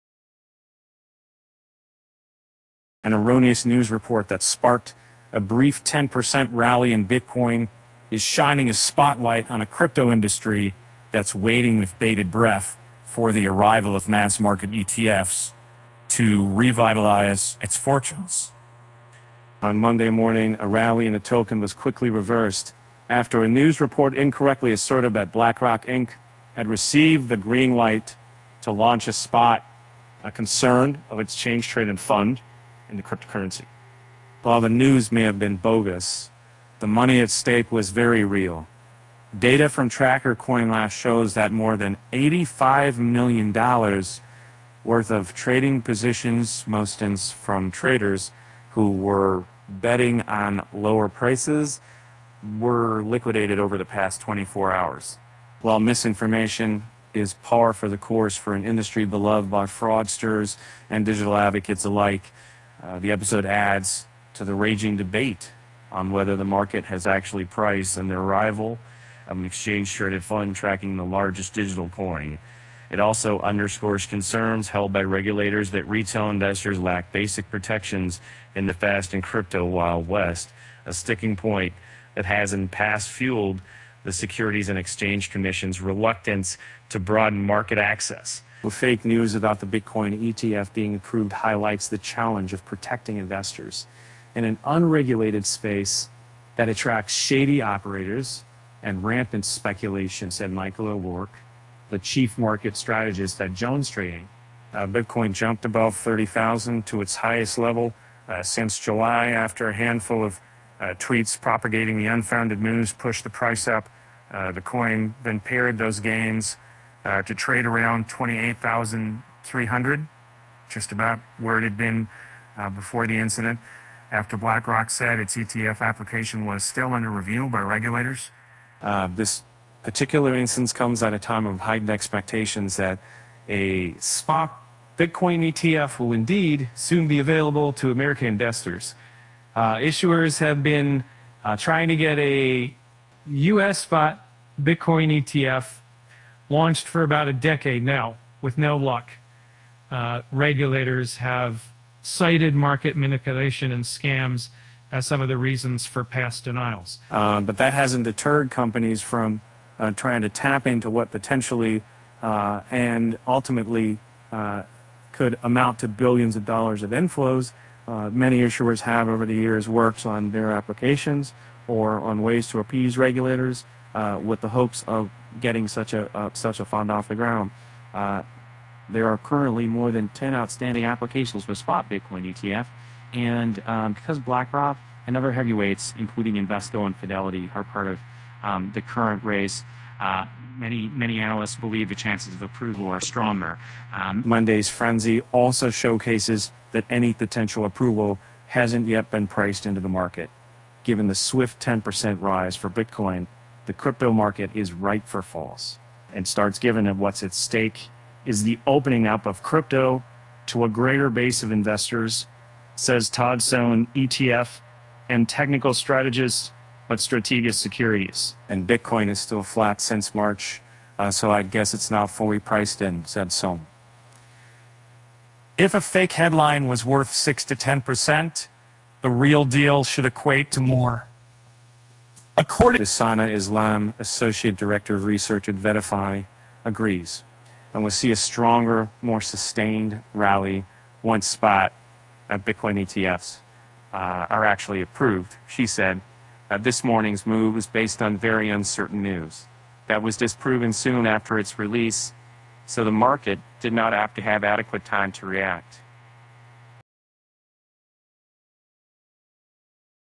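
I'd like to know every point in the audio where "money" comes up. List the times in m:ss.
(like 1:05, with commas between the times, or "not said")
0:36.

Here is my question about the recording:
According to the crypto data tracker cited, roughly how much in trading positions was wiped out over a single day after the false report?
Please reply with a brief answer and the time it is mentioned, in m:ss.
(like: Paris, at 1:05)
$85 million, at 0:42.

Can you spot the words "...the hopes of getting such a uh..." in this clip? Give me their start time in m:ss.
2:54.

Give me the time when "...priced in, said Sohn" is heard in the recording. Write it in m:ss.
3:42.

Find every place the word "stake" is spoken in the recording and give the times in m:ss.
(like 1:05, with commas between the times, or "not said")
0:37, 3:27.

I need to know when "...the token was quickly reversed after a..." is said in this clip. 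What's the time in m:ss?
0:21.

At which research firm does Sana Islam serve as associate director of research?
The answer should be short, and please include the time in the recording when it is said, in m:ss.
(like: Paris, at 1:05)
Vetify, at 3:55.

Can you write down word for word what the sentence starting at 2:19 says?
Uh, issuers have been uh, trying to get a U.S.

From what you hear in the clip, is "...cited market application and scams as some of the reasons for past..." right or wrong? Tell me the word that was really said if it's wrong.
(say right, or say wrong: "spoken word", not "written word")
wrong: "manipulation", not "application".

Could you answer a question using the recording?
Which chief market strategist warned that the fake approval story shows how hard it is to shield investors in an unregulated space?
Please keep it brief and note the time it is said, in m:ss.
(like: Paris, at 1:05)
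Michael O'Rourke, at 1:40.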